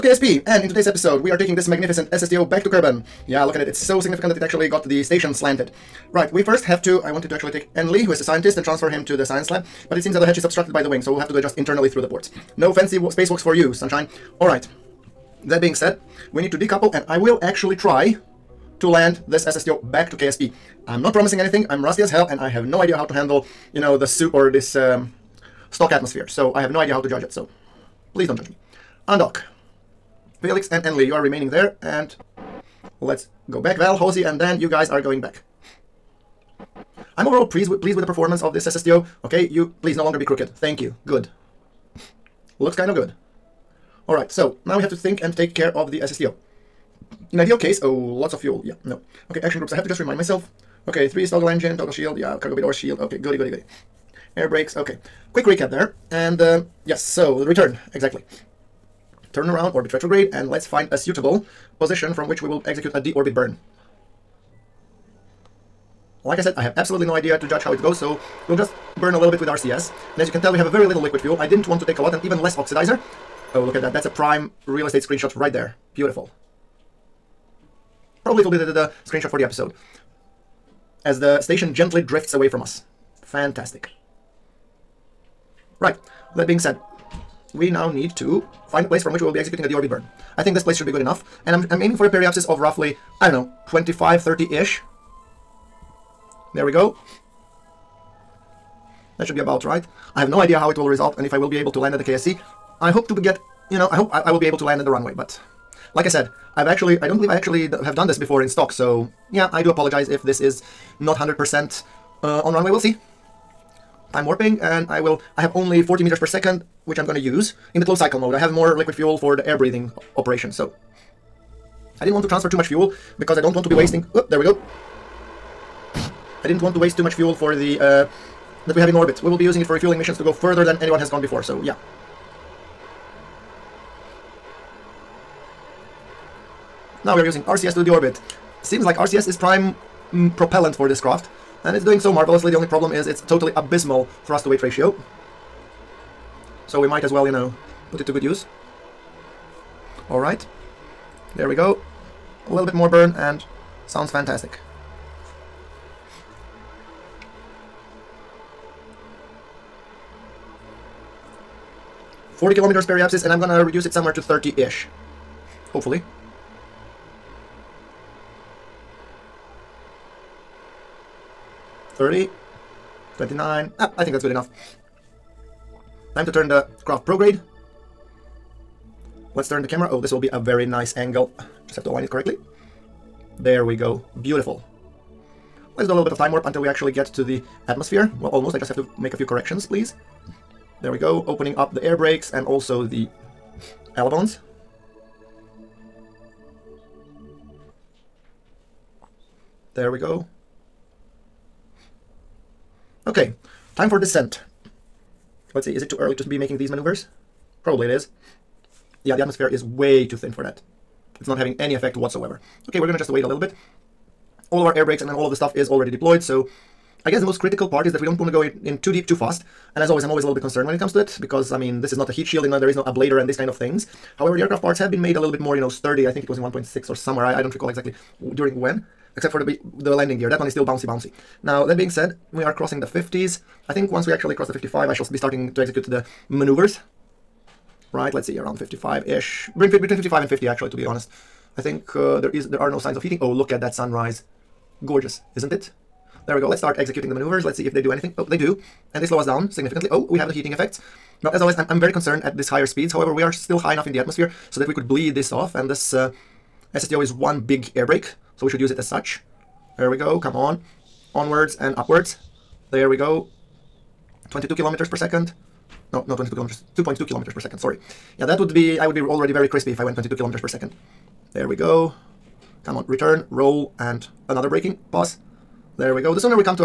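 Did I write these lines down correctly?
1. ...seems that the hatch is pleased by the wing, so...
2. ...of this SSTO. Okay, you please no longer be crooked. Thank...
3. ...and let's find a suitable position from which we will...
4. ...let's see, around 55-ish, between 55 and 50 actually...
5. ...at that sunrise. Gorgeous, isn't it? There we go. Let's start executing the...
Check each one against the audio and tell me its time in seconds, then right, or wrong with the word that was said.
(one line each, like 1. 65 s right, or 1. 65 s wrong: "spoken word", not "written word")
1. 10 s wrong: "obstructed", not "pleased"
2. 38 s right
3. 60 s right
4. 238 s right
5. 243 s right.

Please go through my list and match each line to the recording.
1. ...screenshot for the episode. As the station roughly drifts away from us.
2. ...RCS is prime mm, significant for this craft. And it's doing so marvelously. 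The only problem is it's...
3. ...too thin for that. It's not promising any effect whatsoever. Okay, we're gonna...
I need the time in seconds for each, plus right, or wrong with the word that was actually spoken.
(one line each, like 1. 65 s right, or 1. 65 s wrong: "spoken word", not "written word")
1. 79 s wrong: "gently", not "roughly"
2. 138 s wrong: "propellant", not "significant"
3. 210 s wrong: "having", not "promising".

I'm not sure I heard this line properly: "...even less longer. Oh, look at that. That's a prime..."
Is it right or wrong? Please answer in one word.
wrong.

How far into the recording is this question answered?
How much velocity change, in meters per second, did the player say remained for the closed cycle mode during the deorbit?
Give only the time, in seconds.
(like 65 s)
115 s.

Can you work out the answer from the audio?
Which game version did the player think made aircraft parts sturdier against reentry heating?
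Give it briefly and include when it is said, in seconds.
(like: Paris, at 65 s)
1.6, at 226 s.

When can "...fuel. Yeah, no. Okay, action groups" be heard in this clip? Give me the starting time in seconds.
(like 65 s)
48 s.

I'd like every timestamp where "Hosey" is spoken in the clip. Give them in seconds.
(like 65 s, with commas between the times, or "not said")
33 s.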